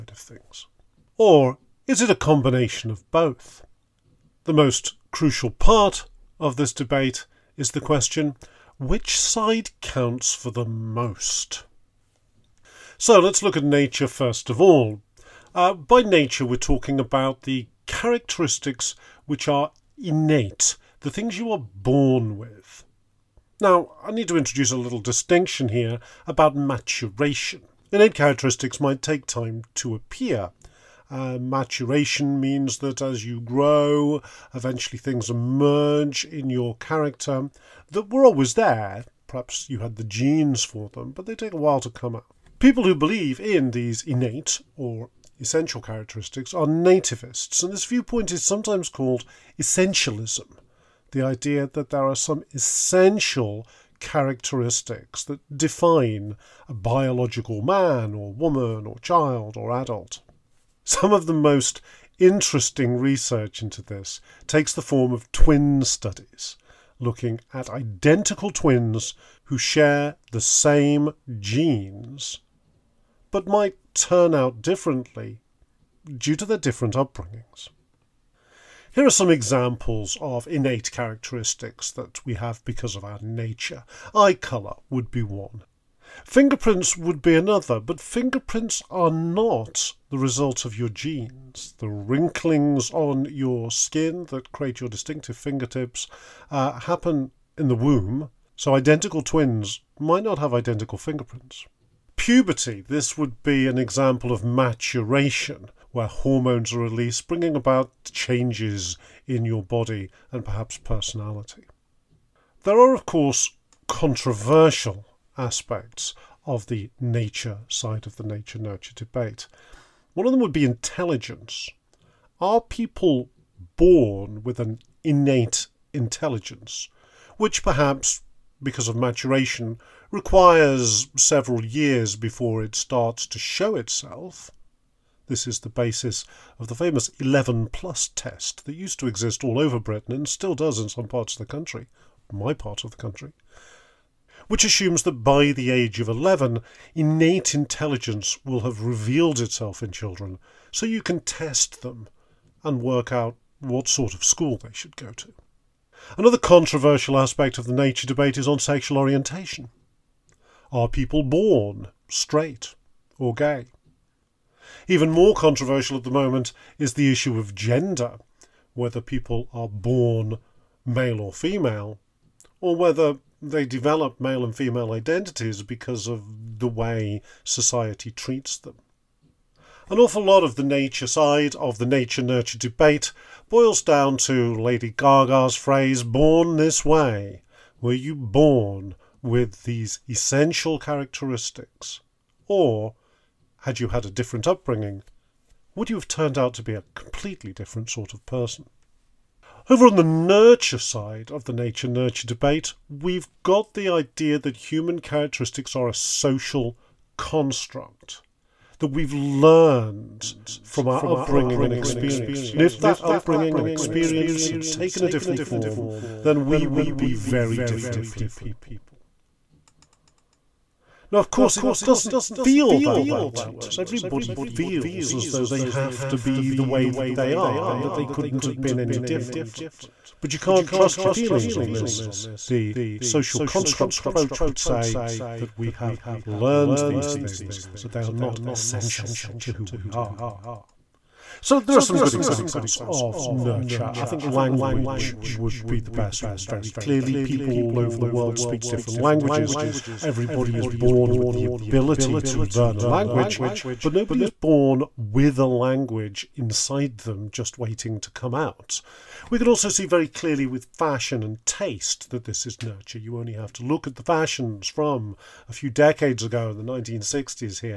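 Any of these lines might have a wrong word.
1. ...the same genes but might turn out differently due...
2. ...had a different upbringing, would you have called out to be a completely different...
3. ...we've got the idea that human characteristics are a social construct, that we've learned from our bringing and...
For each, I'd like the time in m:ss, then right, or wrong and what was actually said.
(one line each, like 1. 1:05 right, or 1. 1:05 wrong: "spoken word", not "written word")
1. 1:10 right
2. 3:13 wrong: "turned", not "called"
3. 3:22 wrong: "upbringing", not "bringing".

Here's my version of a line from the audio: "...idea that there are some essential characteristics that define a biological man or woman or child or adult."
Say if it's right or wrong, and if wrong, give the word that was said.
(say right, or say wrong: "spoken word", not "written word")
right.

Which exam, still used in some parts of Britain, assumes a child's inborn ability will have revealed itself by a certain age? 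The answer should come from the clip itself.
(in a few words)
11 plus test.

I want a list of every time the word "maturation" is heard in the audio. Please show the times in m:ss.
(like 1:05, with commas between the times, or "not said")
0:26, 0:31, 1:44, 2:08.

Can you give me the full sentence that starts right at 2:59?
An awful lot of the nature side of the nature nurture debate boils down to Lady Gaga's phrase, born this way.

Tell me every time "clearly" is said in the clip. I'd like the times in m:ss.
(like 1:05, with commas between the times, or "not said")
4:06, 4:20.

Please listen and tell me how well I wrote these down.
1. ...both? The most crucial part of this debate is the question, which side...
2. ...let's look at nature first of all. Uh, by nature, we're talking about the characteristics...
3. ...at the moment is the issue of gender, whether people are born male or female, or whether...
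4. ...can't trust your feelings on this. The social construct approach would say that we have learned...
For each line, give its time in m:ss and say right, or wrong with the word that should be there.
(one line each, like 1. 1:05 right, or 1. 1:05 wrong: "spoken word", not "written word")
1. 0:03 right
2. 0:13 right
3. 2:45 right
4. 3:50 right.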